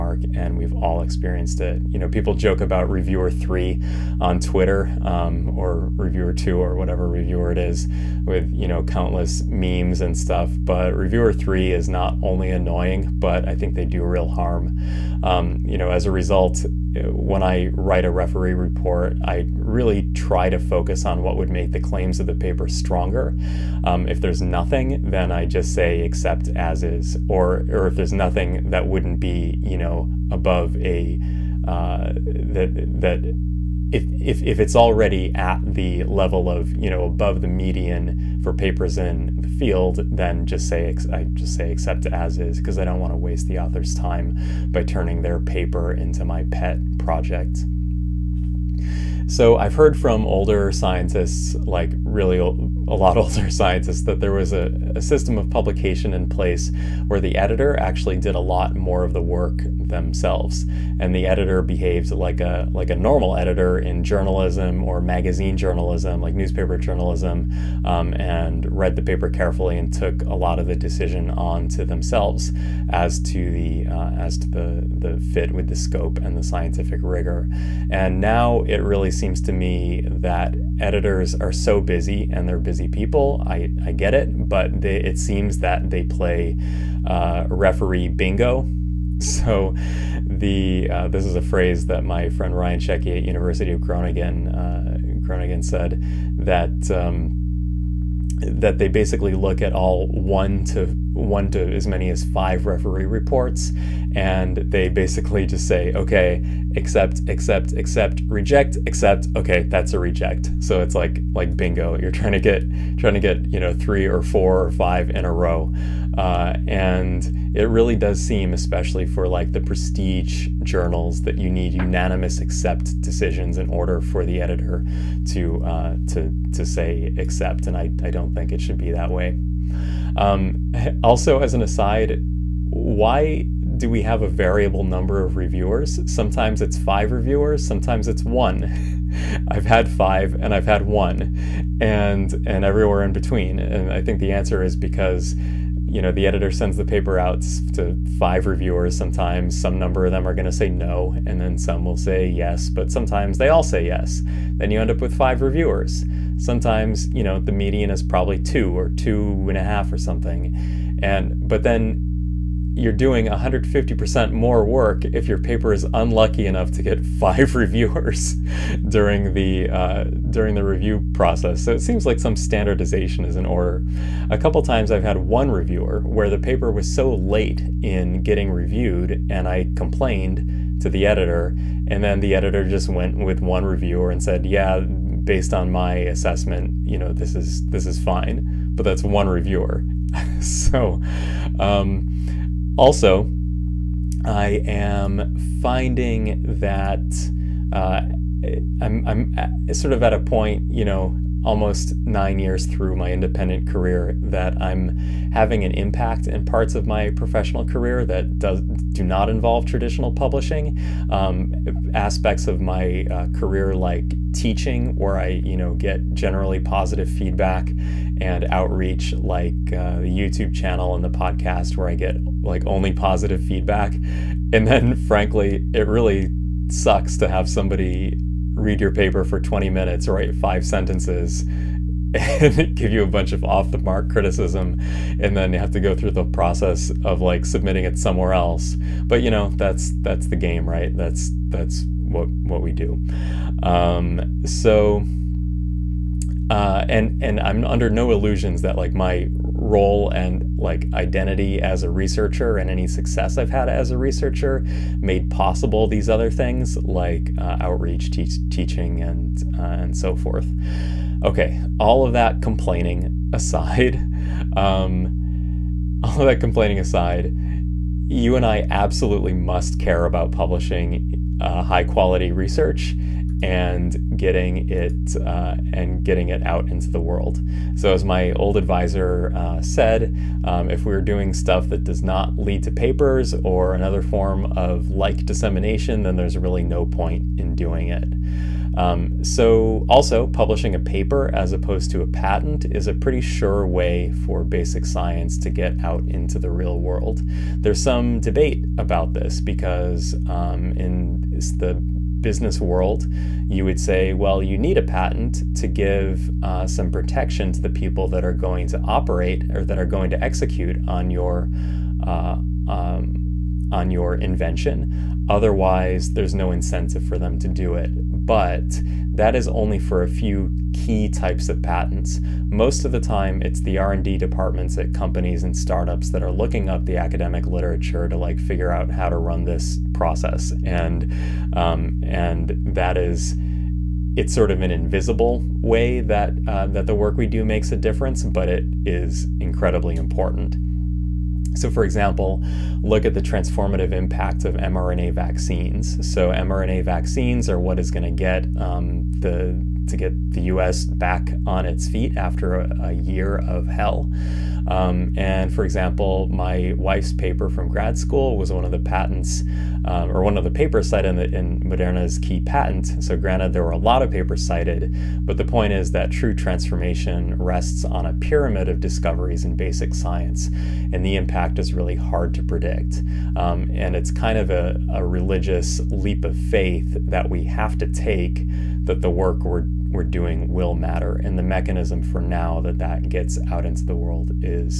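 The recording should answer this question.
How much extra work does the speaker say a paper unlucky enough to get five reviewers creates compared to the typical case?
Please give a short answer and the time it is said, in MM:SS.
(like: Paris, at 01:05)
150% more, at 02:43.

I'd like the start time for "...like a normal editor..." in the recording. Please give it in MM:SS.
01:02.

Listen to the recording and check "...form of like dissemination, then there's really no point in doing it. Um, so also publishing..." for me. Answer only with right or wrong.
right.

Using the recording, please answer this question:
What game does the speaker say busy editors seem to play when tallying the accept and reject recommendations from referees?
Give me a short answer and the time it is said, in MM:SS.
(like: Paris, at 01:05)
Referee bingo, at 01:27.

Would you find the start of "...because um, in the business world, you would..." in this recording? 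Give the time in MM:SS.
04:59.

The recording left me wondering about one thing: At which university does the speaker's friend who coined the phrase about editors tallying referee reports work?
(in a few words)
University of Groningen.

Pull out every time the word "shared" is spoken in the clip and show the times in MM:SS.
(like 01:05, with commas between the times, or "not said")
not said.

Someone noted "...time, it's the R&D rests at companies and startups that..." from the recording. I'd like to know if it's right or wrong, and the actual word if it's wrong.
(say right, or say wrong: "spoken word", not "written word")
wrong: "departments", not "rests".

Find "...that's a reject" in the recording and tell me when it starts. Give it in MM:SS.
01:49.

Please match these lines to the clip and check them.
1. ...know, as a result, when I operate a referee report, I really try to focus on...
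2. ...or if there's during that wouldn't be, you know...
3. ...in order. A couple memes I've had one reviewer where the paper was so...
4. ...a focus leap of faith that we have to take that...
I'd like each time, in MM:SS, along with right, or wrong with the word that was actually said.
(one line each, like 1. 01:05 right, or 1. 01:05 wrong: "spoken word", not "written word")
1. 00:15 wrong: "write", not "operate"
2. 00:27 wrong: "nothing", not "during"
3. 02:53 wrong: "times", not "memes"
4. 06:14 wrong: "religious", not "focus".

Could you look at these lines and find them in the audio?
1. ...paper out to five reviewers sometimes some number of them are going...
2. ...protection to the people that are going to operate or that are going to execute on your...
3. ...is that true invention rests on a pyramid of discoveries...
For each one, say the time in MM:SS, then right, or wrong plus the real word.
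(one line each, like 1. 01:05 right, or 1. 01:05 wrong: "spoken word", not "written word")
1. 02:26 right
2. 05:06 right
3. 06:05 wrong: "transformation", not "invention".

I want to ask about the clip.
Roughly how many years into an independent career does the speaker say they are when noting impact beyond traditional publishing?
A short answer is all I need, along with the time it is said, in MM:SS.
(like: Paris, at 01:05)
Almost 9 years, at 03:21.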